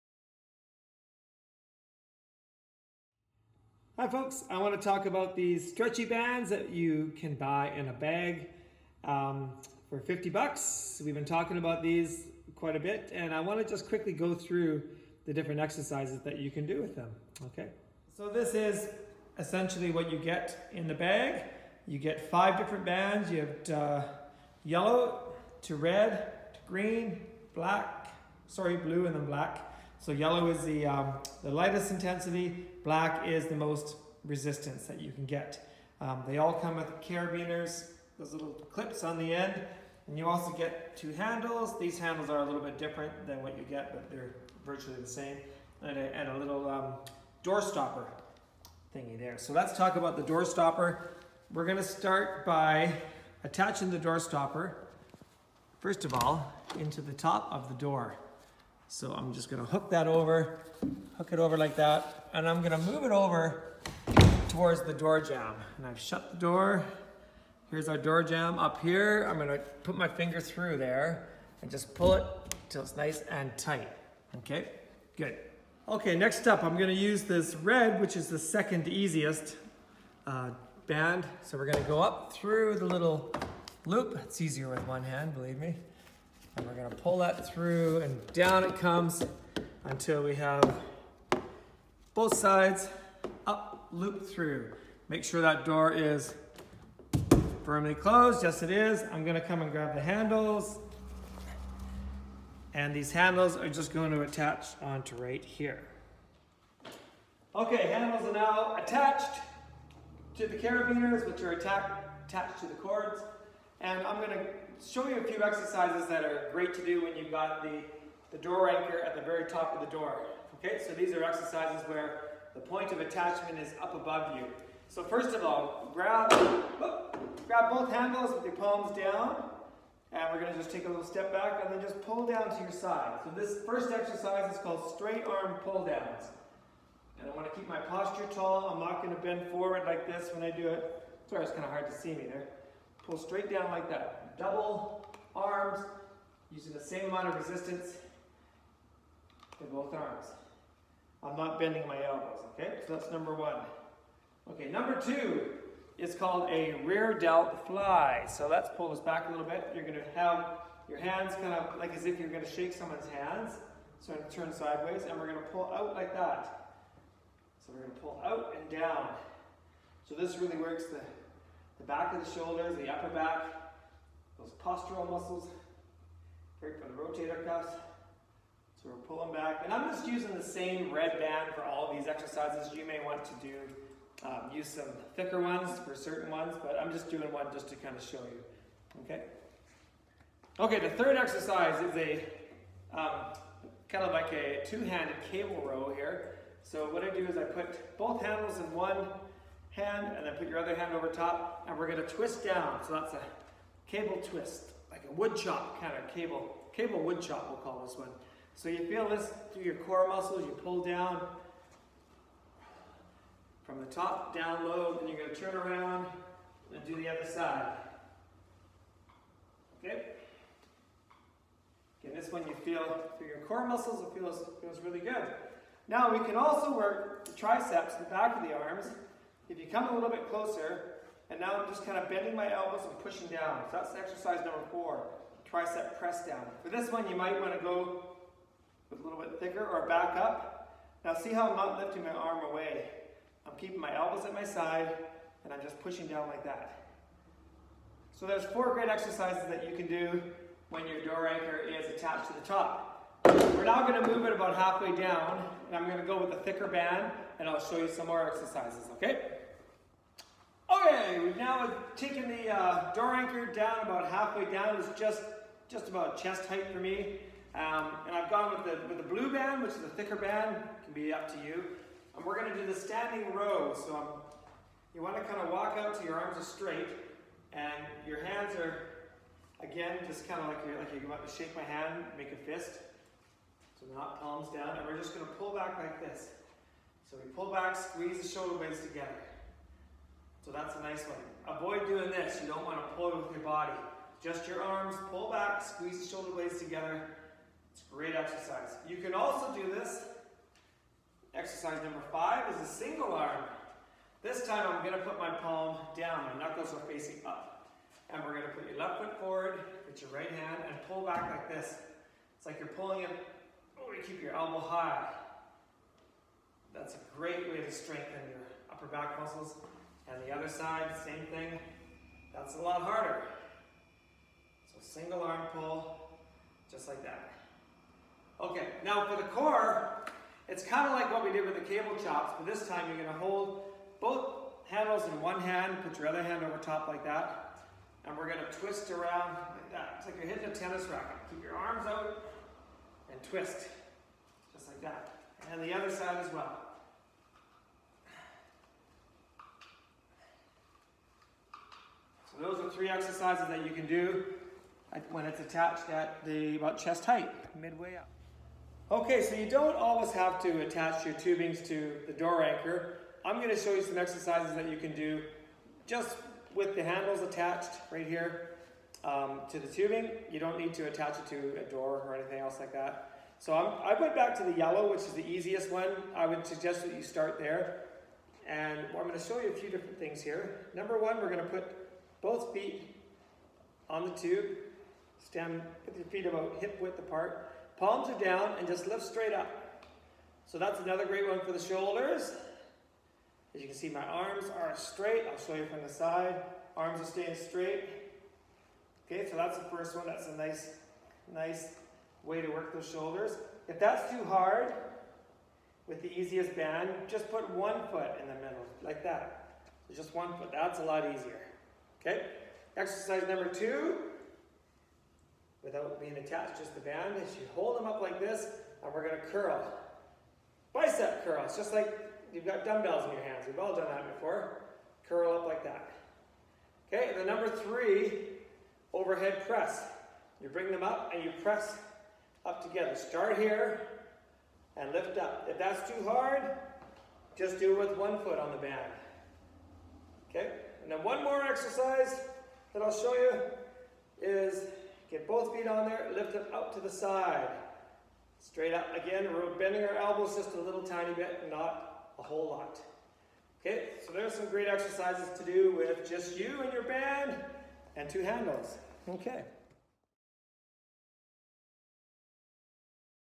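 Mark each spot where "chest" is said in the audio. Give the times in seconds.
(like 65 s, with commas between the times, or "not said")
266 s, 356 s.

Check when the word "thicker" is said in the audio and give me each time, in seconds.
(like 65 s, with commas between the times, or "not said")
185 s, 239 s, 256 s, 269 s.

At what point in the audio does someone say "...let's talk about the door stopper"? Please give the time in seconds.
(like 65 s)
49 s.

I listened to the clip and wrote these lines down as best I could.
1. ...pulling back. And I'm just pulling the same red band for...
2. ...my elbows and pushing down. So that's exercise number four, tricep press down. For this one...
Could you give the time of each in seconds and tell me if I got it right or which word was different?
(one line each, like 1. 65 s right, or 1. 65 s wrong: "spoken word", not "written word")
1. 179 s wrong: "using", not "pulling"
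2. 232 s right.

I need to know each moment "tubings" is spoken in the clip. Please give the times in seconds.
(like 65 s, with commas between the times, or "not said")
361 s, 369 s.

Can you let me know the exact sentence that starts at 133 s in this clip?
So this first exercise is called straight arm pull downs.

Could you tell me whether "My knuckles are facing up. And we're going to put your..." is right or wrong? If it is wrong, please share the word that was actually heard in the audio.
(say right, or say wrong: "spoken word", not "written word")
right.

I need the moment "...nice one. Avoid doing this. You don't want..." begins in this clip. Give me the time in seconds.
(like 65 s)
290 s.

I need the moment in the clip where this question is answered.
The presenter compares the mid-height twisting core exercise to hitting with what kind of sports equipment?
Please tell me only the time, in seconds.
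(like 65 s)
340 s.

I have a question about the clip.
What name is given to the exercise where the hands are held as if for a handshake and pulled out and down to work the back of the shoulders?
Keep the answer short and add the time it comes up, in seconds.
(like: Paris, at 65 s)
Rear delt fly, at 156 s.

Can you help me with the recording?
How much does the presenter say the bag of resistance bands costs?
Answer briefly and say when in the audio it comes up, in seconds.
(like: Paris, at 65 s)
$50, at 9 s.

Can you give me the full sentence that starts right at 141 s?
Sorry, it's kind of hard to see me there.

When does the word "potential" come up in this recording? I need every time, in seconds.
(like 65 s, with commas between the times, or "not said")
not said.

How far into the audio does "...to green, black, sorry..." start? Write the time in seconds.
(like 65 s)
26 s.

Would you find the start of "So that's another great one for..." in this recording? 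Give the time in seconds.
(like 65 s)
390 s.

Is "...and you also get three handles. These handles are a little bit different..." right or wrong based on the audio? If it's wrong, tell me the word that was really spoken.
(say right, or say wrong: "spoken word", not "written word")
wrong: "two", not "three".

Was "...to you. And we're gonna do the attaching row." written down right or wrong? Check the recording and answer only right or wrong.
wrong.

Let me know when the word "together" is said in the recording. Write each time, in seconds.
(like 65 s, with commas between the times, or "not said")
288 s, 296 s, 432 s.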